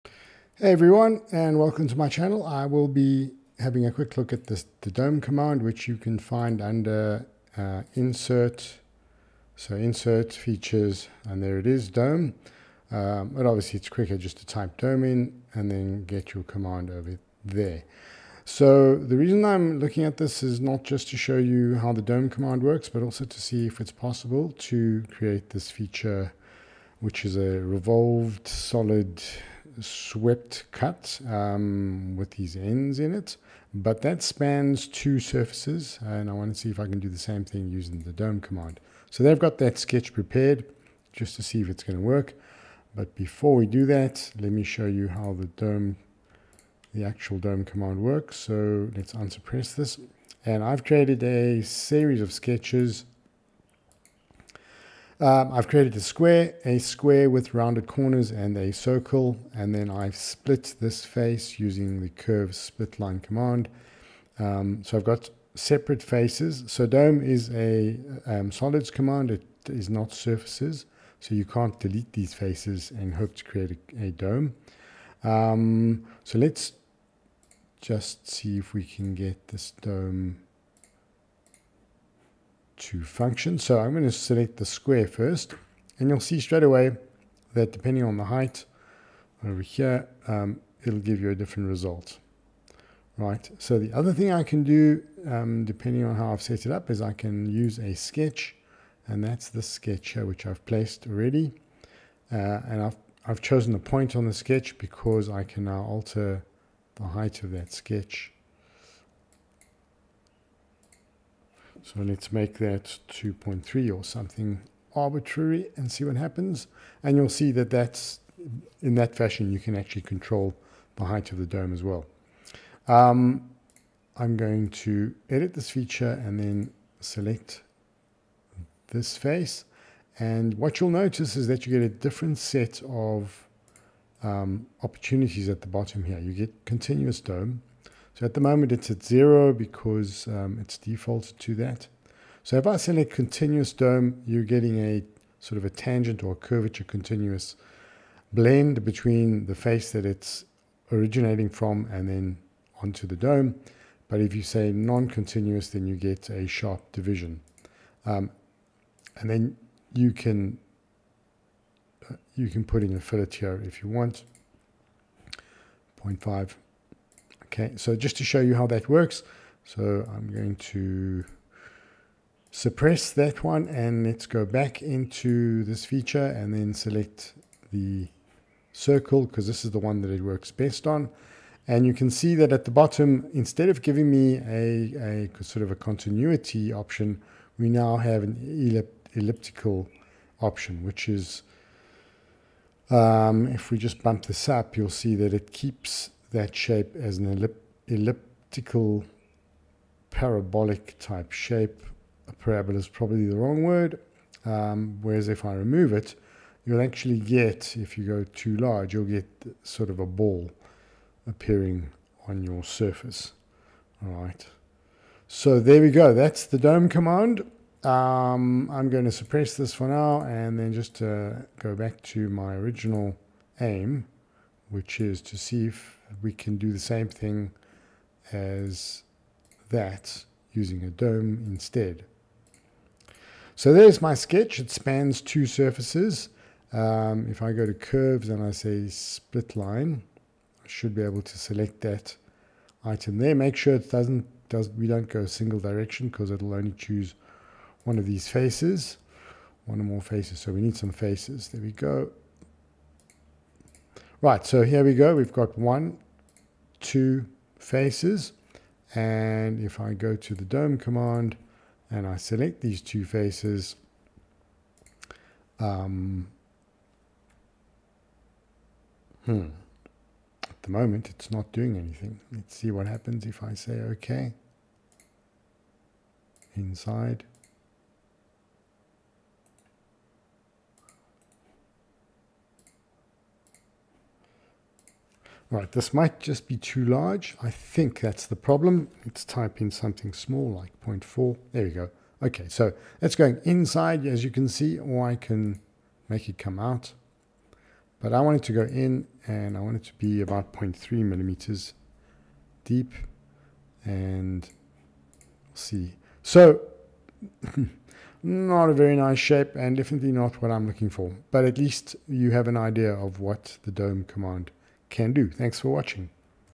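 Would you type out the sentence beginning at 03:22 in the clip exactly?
A parabola is probably the wrong word.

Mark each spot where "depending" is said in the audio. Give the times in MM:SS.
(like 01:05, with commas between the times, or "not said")
01:27, 01:35.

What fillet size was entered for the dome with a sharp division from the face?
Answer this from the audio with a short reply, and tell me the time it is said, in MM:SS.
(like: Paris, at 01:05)
0.5, at 02:46.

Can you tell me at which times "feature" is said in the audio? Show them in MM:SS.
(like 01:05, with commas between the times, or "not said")
00:10, 00:25, 02:05, 02:55.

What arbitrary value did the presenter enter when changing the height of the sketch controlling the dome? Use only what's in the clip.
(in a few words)
2.3.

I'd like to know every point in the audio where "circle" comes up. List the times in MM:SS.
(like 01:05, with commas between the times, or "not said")
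00:58, 02:58.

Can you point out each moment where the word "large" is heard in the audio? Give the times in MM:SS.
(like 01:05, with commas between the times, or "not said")
03:28, 04:46.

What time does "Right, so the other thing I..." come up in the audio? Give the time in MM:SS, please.
01:33.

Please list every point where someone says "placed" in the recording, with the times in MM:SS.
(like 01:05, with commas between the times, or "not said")
01:40.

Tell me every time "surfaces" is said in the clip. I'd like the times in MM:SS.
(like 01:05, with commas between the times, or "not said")
00:35, 01:10, 03:32, 03:55.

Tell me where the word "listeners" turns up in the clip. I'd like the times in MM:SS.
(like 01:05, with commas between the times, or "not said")
not said.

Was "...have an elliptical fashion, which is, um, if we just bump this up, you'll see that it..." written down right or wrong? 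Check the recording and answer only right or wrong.
wrong.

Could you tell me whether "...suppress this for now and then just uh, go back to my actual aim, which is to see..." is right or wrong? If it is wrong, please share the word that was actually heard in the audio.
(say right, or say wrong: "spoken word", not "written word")
wrong: "original", not "actual".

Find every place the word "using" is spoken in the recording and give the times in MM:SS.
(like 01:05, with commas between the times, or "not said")
00:37, 01:01, 03:50.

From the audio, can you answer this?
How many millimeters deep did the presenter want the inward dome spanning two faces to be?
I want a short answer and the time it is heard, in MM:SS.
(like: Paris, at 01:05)
0.3, at 05:00.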